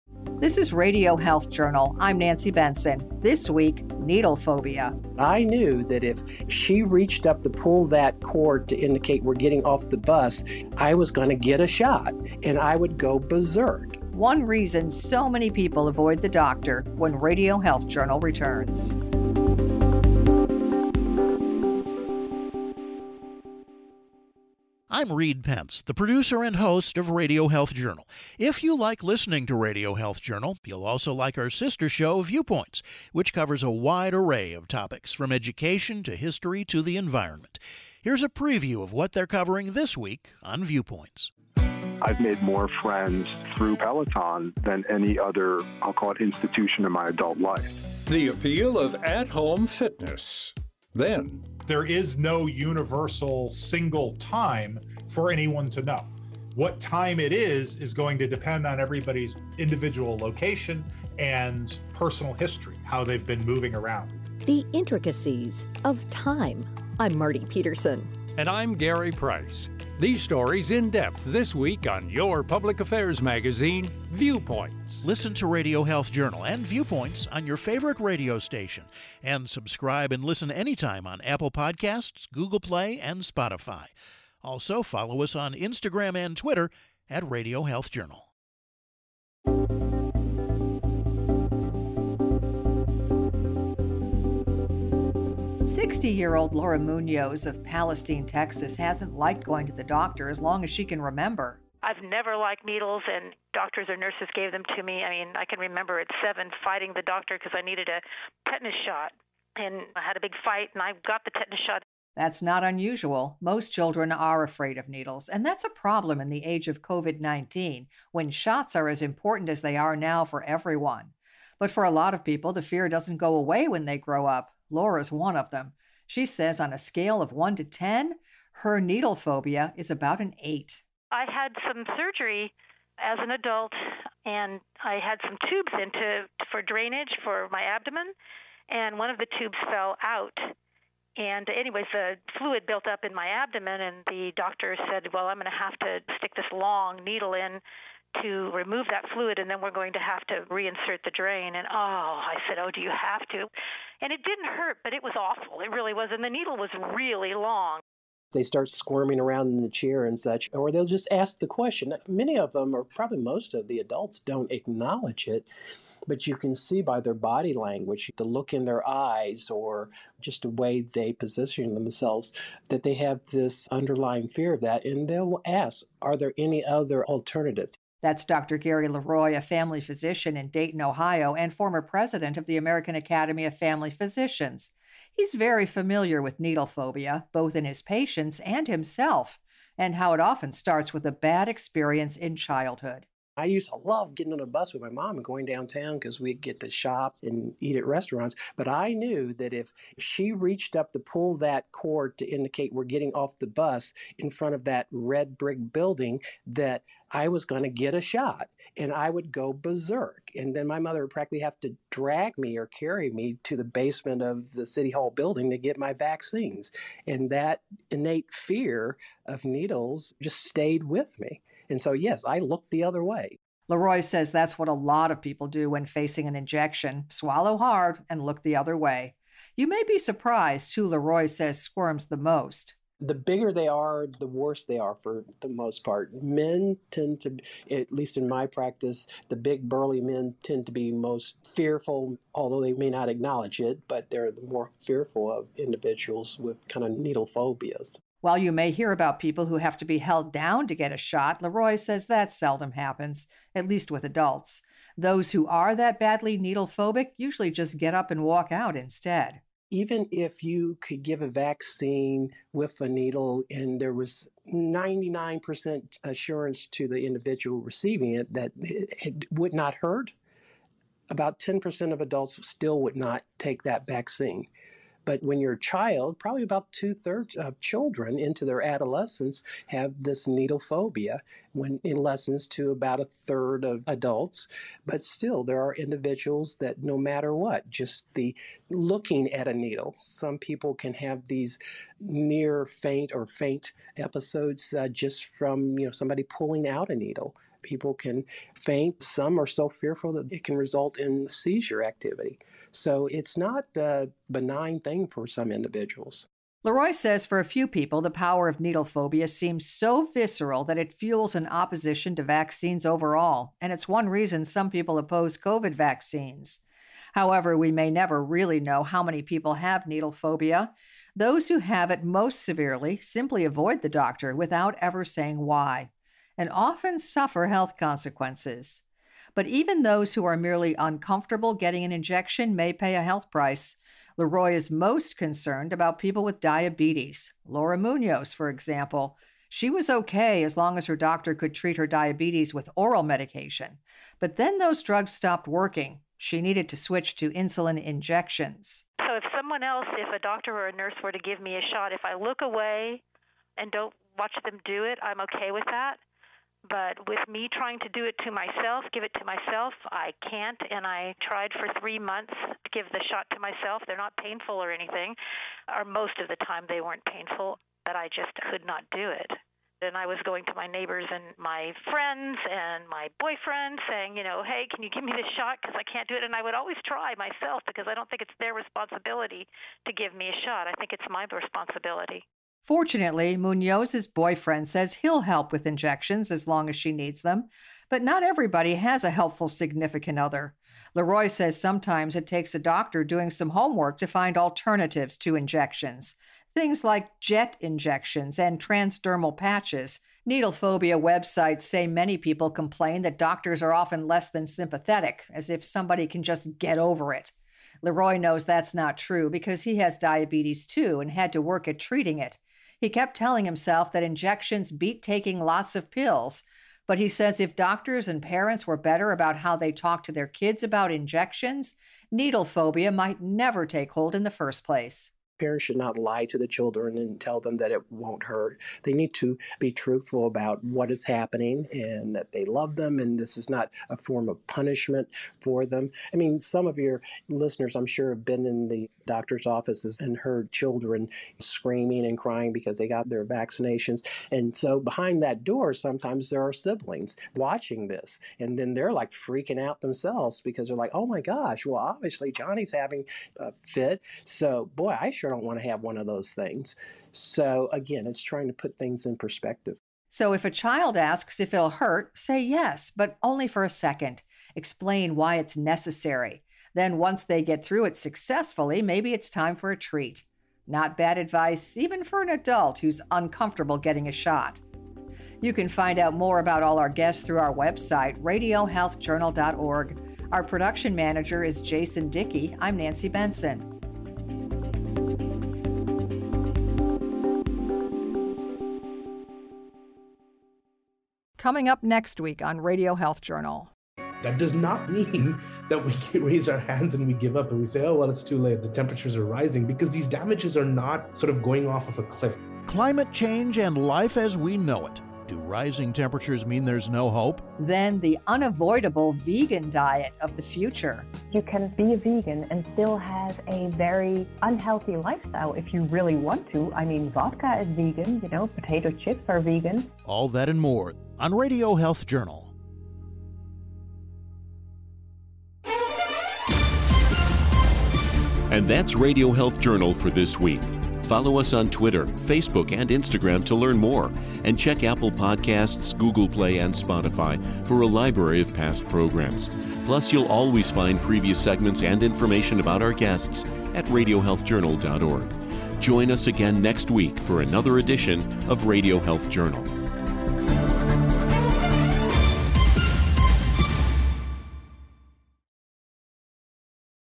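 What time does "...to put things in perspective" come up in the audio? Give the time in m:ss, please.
7:38.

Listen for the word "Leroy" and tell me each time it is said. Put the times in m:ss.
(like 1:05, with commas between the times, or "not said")
2:58, 3:43, 3:50, 4:11, 5:06, 5:34, 6:30, 6:47.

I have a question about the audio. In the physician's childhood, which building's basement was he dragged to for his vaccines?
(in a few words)
City hall.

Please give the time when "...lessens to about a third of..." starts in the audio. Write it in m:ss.
4:41.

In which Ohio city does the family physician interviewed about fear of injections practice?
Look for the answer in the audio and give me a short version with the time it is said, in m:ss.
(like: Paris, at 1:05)
Dayton, at 3:00.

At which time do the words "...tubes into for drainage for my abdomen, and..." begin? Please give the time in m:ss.
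2:15.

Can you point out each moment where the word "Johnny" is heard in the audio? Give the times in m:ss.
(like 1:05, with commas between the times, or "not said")
7:32.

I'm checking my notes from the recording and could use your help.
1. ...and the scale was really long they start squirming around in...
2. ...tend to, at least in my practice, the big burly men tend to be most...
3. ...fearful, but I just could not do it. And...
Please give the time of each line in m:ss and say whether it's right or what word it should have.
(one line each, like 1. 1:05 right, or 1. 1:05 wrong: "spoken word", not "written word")
1. 2:36 wrong: "needle", not "scale"
2. 3:56 right
3. 6:07 wrong: "painful", not "fearful".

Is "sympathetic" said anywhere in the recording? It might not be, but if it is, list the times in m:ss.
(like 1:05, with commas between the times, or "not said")
6:44.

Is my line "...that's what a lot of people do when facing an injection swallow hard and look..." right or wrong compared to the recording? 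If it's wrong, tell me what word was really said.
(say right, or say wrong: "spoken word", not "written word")
right.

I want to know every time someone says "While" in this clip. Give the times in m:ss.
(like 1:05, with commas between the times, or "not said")
4:08.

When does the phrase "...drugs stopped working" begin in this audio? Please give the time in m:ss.
5:44.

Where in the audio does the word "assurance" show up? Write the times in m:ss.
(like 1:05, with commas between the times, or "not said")
4:26.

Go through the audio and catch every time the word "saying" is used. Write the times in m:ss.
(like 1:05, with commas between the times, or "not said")
5:25, 6:13.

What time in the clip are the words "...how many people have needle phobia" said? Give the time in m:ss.
5:18.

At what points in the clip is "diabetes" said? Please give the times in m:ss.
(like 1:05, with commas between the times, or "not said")
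5:36, 5:41, 6:49.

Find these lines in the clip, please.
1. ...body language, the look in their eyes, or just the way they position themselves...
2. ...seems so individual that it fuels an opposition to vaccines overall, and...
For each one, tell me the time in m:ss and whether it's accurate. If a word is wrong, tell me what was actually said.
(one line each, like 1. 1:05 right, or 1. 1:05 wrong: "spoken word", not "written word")
1. 2:47 right
2. 5:09 wrong: "visceral", not "individual".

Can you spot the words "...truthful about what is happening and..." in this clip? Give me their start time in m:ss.
7:09.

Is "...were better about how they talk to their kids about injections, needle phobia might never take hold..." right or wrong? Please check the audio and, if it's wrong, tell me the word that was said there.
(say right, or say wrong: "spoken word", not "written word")
right.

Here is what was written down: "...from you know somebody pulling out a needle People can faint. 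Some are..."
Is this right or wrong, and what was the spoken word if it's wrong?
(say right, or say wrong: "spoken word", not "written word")
right.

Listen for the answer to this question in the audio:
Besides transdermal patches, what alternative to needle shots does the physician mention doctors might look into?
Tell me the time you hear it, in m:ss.
6:37.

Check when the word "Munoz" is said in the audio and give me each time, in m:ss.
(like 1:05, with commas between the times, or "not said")
1:36, 5:37, 6:23.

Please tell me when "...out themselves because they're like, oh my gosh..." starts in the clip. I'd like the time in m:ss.
7:29.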